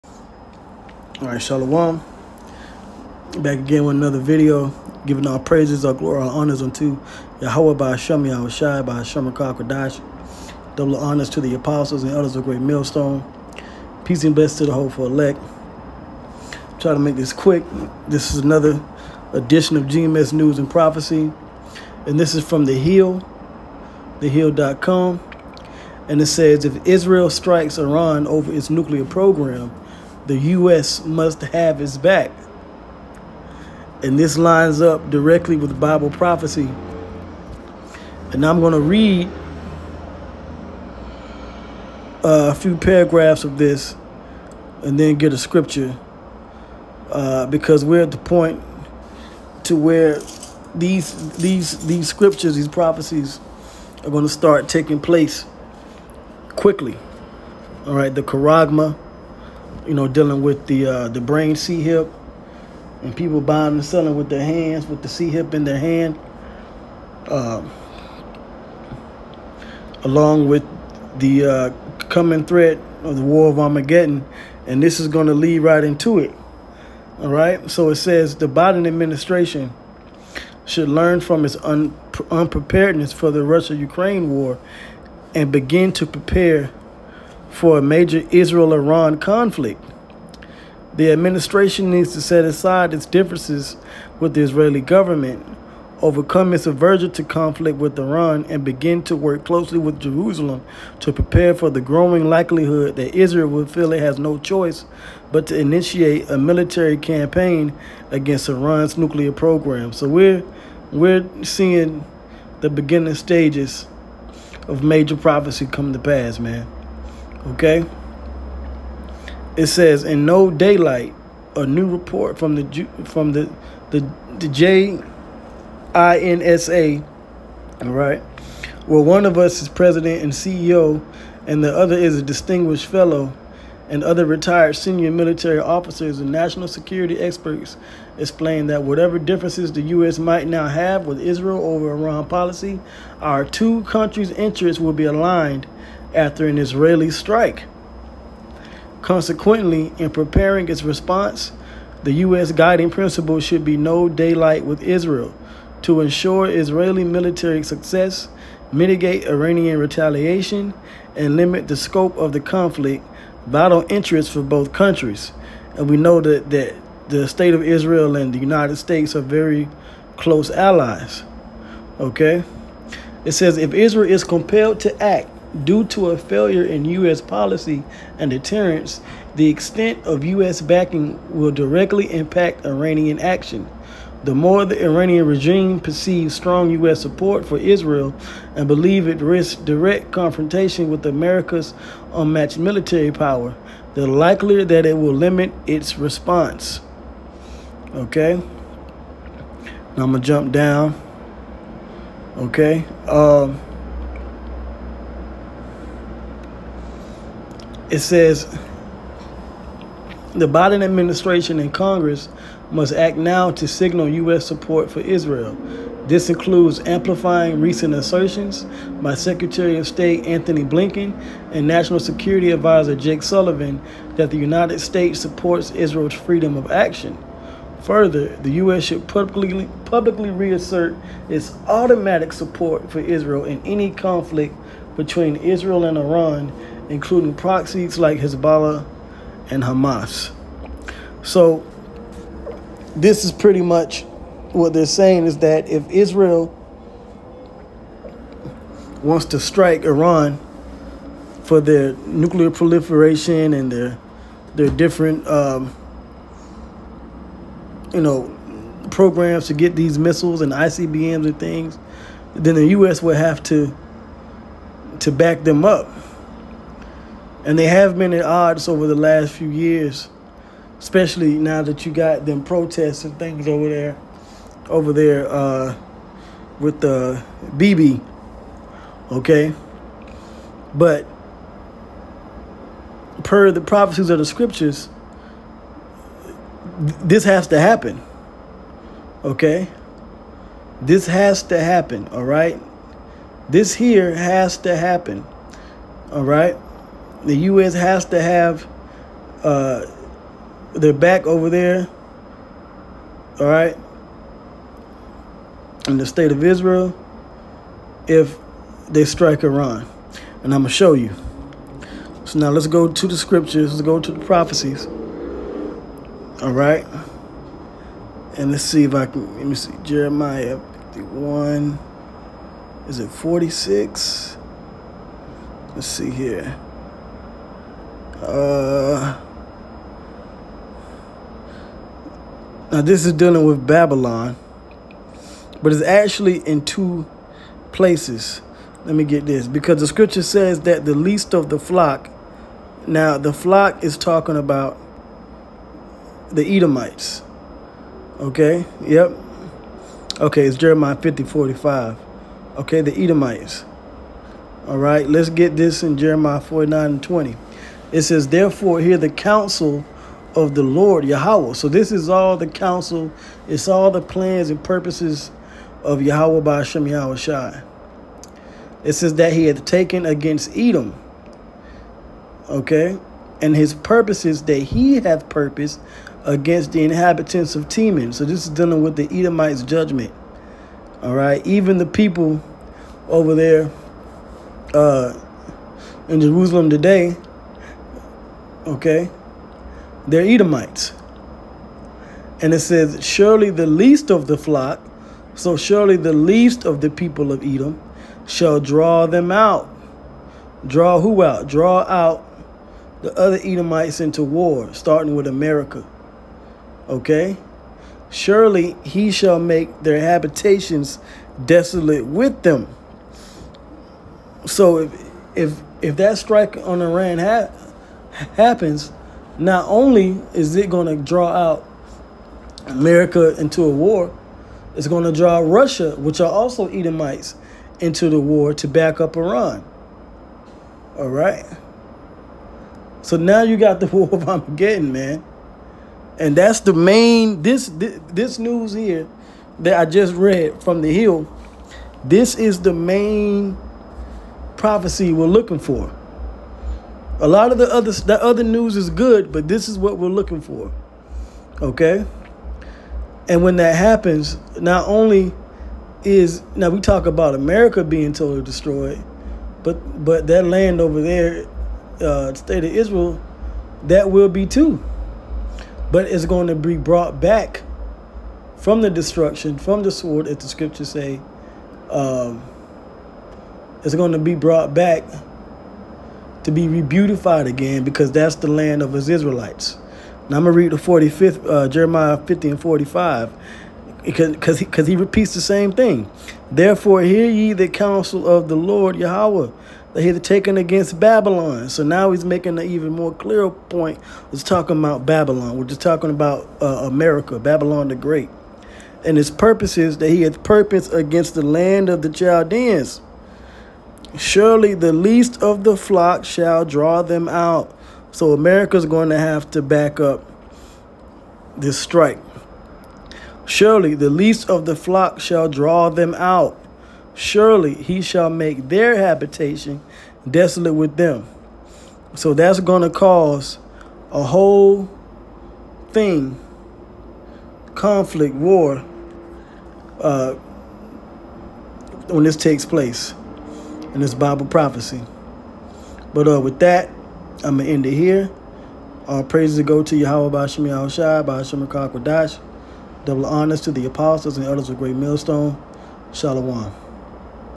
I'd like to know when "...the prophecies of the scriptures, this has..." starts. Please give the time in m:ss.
4:43.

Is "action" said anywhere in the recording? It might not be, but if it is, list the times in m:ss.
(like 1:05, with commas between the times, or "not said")
3:03, 3:46.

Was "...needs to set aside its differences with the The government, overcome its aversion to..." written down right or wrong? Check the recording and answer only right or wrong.
wrong.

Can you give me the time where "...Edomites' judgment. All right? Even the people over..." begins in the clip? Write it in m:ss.
6:19.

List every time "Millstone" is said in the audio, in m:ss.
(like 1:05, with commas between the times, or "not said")
0:12, 9:04.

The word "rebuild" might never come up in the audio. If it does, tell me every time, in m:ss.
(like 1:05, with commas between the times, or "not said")
not said.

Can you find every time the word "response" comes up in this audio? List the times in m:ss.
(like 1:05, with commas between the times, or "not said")
2:30, 3:15.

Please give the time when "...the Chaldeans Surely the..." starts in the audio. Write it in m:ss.
8:22.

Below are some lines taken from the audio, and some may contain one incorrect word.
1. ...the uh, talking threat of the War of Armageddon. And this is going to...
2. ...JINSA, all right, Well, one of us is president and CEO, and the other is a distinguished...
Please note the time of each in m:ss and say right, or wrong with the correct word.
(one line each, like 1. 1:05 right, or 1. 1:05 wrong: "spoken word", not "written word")
1. 1:11 wrong: "coming", not "talking"
2. 2:04 right.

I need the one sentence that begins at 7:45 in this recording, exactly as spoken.
But it's going to be brought back from the destruction, from the sword, as the scriptures say.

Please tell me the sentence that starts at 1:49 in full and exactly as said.
So we're we're seeing the beginning stages of major prophecy come to pass, man.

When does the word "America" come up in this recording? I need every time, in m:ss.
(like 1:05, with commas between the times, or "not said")
3:11, 6:45, 7:02, 7:37, 8:16, 8:28.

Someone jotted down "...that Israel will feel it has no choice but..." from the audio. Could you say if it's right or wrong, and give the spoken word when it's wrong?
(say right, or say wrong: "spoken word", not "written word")
right.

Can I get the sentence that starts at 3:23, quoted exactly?
Um, it says the Biden administration and Congress must act now to signal U.S.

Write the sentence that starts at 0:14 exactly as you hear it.
Peace and best to the hopeful elect.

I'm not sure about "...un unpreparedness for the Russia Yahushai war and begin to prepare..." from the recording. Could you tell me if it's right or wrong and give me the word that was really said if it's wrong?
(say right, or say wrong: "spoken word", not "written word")
wrong: "Ukraine", not "Yahushai".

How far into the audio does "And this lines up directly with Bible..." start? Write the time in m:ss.
0:34.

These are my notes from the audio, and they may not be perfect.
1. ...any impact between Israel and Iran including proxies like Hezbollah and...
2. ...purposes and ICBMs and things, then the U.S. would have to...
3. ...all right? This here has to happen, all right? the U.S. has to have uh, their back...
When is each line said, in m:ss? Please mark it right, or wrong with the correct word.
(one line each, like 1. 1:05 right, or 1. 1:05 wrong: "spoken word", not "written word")
1. 3:53 wrong: "conflict", not "impact"
2. 4:19 wrong: "missiles", not "purposes"
3. 4:52 right.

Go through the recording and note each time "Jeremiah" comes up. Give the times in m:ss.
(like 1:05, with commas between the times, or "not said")
5:19, 5:50, 5:55, 8:01.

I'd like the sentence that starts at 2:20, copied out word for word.
might now have with Israel over Iran policy, our two countries' interests will be aligned after an Israeli strike.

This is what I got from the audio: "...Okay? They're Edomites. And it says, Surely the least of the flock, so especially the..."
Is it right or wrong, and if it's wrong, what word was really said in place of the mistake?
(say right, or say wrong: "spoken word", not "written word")
wrong: "surely", not "especially".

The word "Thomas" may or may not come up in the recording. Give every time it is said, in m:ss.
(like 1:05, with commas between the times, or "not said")
not said.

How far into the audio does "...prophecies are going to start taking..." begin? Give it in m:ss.
0:52.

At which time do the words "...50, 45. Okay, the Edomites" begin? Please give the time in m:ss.
5:50.